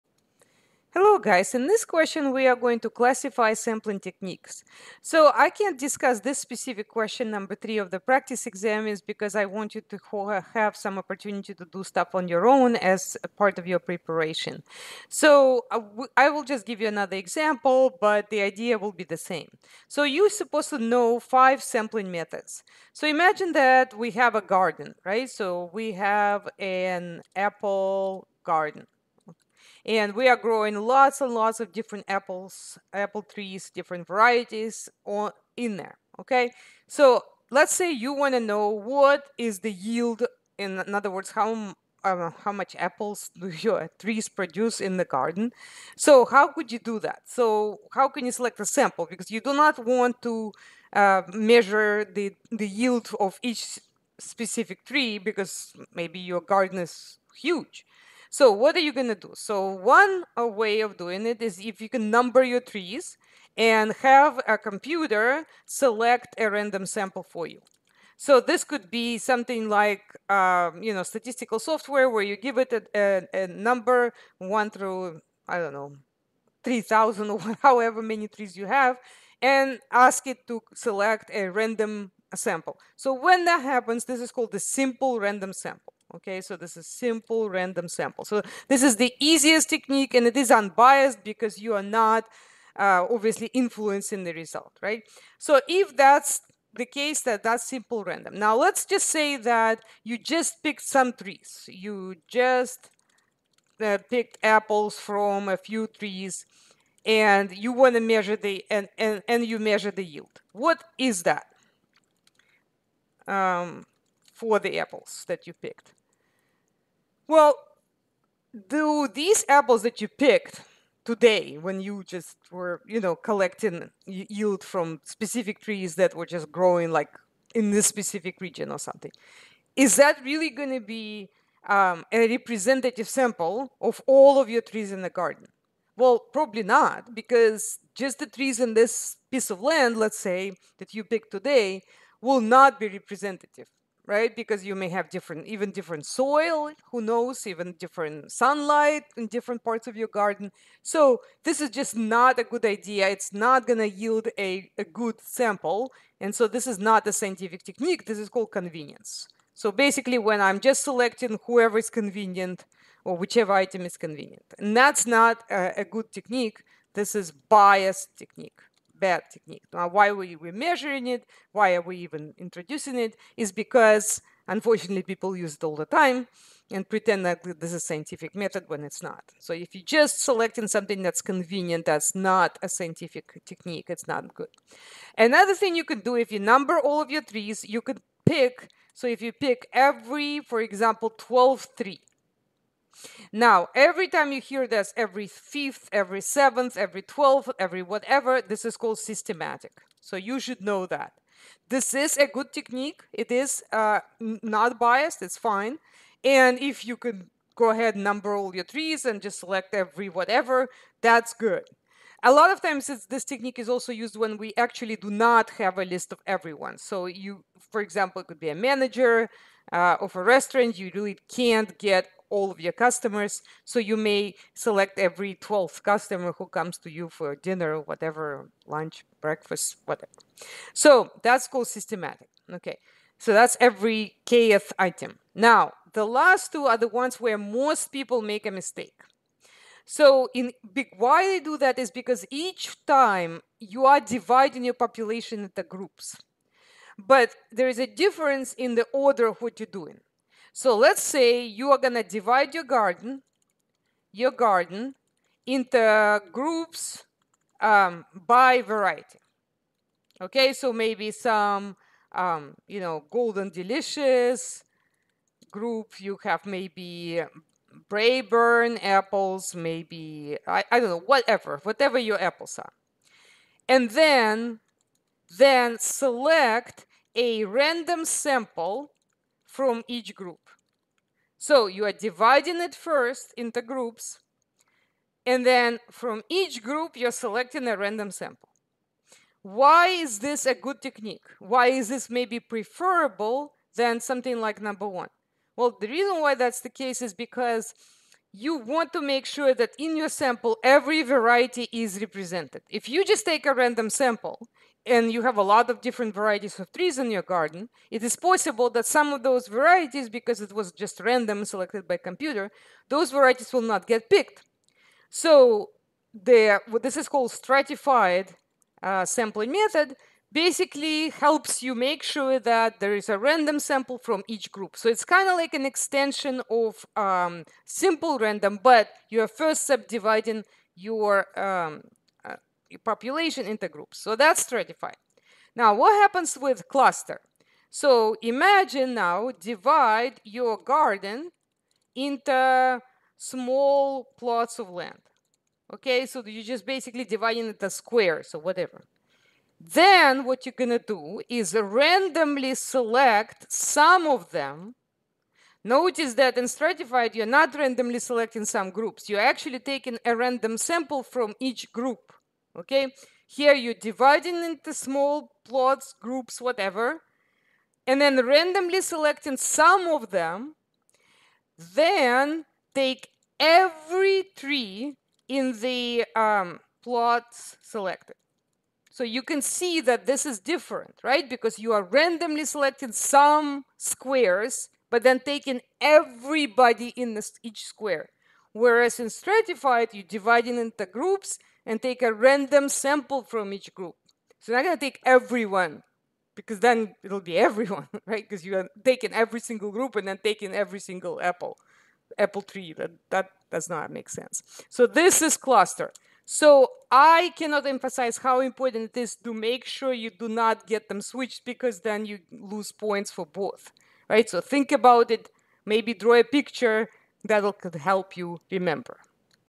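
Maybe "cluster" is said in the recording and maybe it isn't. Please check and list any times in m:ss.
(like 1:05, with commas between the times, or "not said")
5:36, 6:45.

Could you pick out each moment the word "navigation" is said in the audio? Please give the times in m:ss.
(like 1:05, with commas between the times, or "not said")
not said.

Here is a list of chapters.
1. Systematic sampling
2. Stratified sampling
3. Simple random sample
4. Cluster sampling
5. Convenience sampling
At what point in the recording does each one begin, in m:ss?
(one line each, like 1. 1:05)
1. 3:04
2. 3:56
3. 0:59
4. 5:35
5. 1:38.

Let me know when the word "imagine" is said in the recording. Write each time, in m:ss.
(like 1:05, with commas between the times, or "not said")
0:23, 5:38.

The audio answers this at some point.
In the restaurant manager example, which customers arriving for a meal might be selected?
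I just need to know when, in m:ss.
3:45.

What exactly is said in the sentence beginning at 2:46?
This is biased technique bad technique.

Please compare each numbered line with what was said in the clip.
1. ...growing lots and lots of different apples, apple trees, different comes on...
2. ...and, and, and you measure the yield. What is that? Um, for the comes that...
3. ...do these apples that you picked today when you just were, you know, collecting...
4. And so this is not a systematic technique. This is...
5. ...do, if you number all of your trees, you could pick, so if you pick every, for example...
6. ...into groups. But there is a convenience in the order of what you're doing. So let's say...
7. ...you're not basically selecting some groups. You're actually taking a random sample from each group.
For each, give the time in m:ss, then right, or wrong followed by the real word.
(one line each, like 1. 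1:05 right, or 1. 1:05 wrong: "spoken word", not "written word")
1. 0:30 wrong: "varieties", not "comes"
2. 1:48 wrong: "apples", not "comes"
3. 1:58 right
4. 2:36 wrong: "scientific", not "systematic"
5. 3:06 right
6. 4:05 wrong: "difference", not "convenience"
7. 5:57 wrong: "randomly", not "basically".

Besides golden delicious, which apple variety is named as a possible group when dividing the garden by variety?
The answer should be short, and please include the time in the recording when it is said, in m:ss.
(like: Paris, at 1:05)
Braeburn, at 4:27.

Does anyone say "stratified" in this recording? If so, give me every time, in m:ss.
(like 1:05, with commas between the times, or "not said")
5:17, 5:34, 5:56, 6:29.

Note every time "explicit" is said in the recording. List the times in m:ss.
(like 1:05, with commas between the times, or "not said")
not said.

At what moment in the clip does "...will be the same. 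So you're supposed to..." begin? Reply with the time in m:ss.
0:18.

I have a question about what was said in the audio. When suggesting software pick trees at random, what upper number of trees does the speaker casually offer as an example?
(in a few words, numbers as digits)
3000.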